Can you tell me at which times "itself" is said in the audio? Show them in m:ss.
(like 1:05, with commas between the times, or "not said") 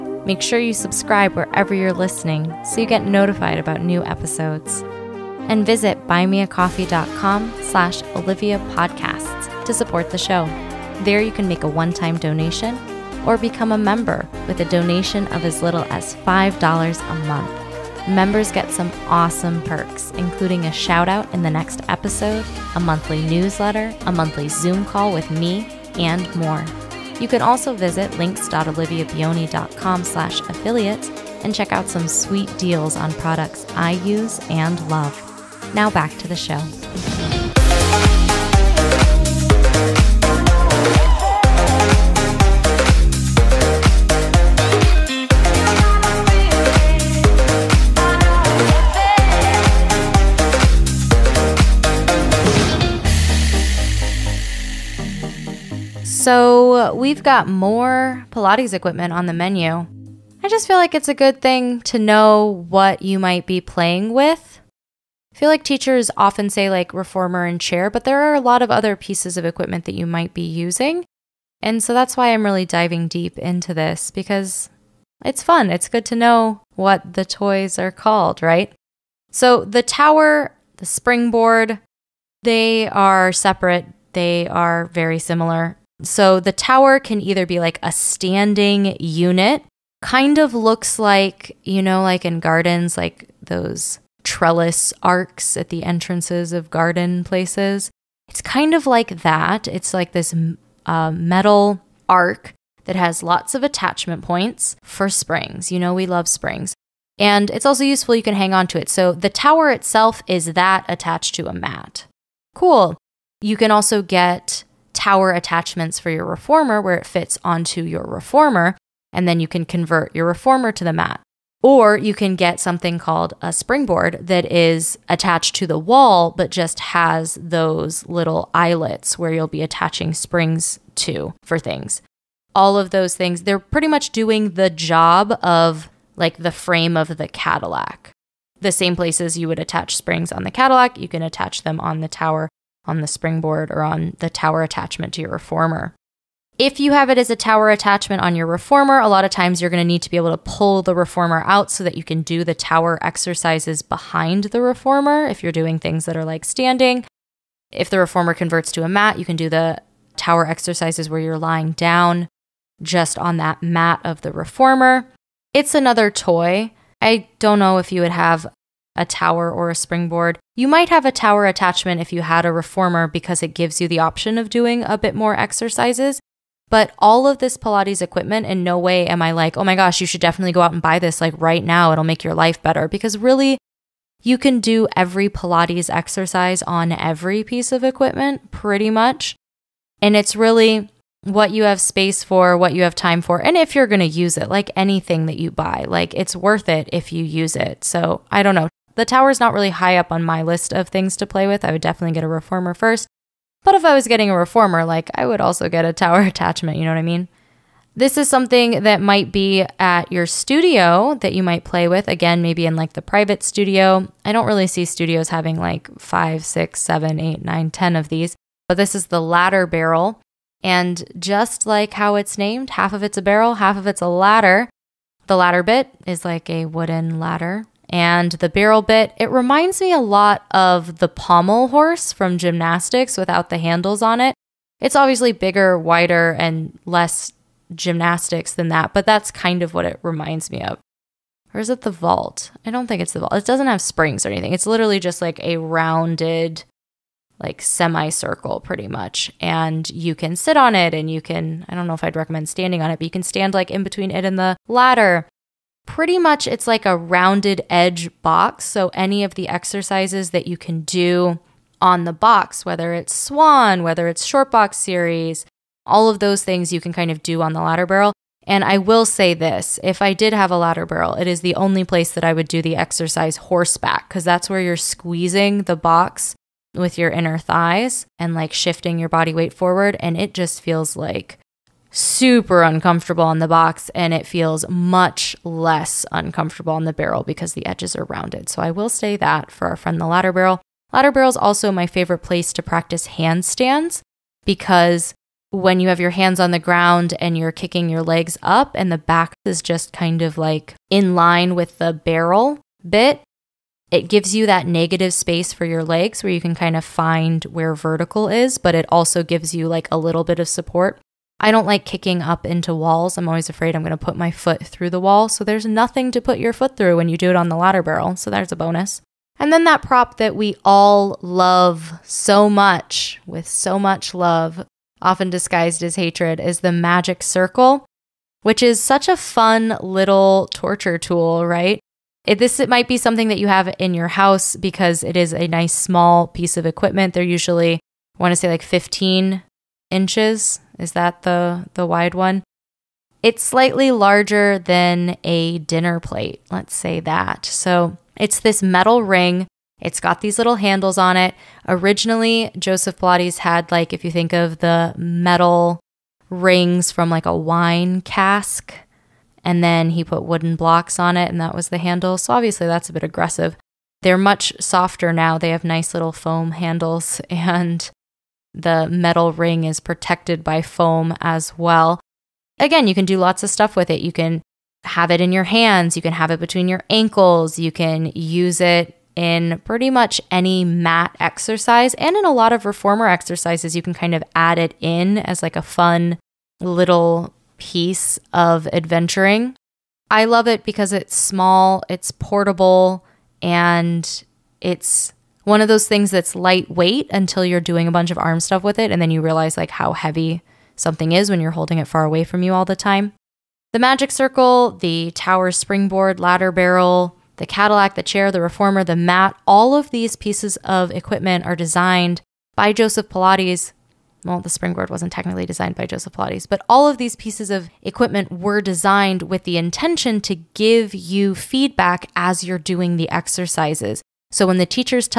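1:49.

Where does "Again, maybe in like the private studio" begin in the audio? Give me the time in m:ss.
3:32.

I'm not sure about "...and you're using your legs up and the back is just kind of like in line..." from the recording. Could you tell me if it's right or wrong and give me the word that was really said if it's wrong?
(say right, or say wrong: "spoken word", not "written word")
wrong: "kicking", not "using".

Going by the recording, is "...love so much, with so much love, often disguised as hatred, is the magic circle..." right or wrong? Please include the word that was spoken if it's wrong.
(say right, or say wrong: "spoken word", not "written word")
right.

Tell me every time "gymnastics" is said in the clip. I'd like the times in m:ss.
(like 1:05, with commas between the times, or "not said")
3:52, 3:57.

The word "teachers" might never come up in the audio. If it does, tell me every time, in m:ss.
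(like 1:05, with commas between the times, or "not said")
1:05, 7:04.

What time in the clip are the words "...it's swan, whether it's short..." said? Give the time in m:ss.
4:22.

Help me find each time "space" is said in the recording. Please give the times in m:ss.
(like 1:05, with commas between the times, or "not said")
3:11, 5:05.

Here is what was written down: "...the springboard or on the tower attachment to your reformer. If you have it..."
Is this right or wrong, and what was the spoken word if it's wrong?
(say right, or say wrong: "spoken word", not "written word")
right.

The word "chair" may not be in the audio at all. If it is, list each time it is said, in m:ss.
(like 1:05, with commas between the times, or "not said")
1:07, 6:48.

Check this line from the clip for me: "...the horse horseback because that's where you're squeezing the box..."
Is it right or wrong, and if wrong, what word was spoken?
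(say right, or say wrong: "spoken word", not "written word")
wrong: "exercise", not "horse".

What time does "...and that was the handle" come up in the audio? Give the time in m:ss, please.
6:01.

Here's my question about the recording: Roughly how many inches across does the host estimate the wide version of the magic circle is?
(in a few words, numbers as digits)
15.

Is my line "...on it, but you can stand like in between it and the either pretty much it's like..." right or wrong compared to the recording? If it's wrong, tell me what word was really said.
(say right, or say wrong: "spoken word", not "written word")
wrong: "ladder", not "either".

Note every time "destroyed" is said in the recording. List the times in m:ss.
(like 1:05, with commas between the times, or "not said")
not said.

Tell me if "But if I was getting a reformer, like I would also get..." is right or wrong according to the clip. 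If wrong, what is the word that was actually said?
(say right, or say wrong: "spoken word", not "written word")
right.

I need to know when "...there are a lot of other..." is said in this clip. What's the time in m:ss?
1:08.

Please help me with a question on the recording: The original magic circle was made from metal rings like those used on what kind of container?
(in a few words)
wine cask.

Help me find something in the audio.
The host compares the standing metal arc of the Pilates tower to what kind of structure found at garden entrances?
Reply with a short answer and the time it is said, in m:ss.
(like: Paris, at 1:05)
trellis arcs, at 1:34.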